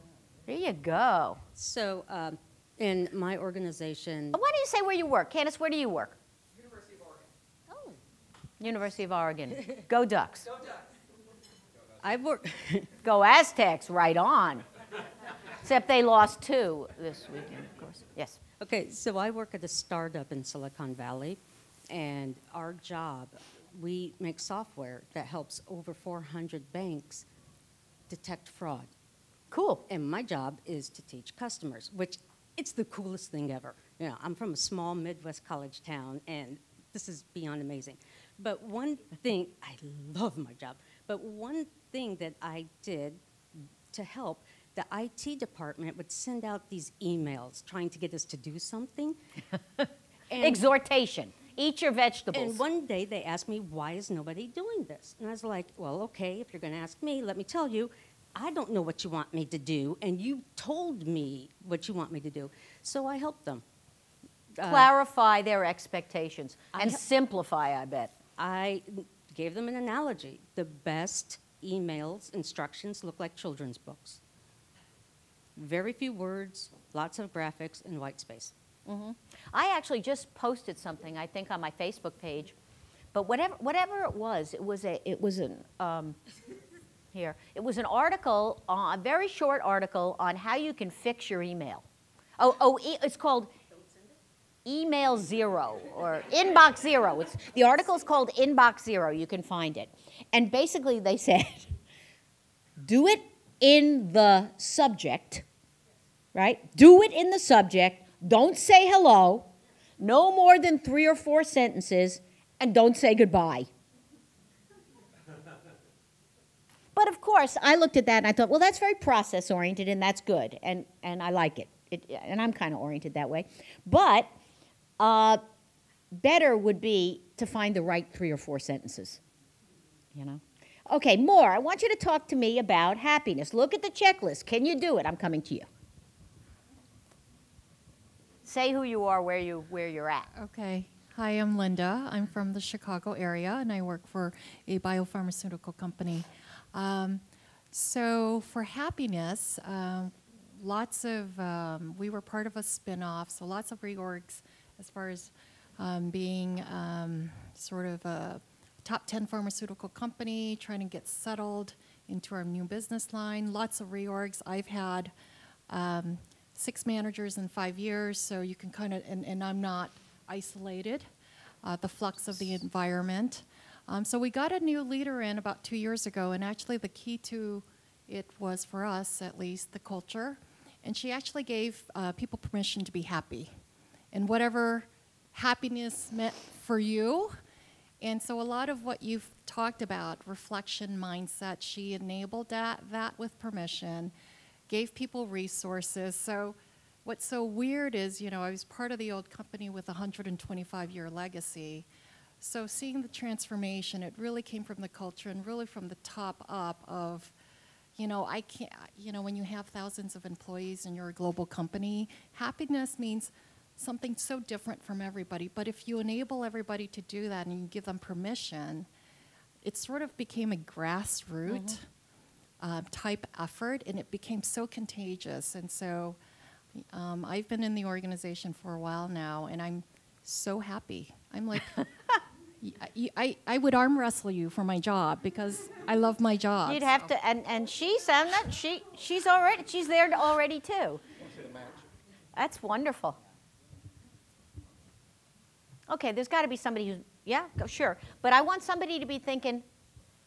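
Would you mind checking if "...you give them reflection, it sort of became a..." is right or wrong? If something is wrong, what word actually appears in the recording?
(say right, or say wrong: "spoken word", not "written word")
wrong: "permission", not "reflection".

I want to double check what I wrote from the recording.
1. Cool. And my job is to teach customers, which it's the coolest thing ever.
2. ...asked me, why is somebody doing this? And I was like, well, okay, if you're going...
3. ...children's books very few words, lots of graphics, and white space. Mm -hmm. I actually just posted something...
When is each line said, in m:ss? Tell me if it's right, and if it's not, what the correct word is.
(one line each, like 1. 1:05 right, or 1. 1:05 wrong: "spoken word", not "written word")
1. 0:29 right
2. 0:53 wrong: "nobody", not "somebody"
3. 1:13 right.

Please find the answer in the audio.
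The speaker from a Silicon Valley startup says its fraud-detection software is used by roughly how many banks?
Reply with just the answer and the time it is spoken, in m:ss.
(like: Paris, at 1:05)
400, at 0:25.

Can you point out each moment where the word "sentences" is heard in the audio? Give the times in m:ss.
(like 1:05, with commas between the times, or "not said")
1:51, 2:08.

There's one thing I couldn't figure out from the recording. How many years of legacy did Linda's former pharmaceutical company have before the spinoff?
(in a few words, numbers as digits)
125.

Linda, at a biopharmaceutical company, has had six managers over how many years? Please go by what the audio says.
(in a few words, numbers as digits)
5.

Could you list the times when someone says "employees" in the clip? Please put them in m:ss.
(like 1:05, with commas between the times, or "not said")
3:30.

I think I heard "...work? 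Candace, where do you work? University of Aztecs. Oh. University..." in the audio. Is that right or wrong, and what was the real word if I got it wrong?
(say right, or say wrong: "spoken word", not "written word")
wrong: "Oregon", not "Aztecs".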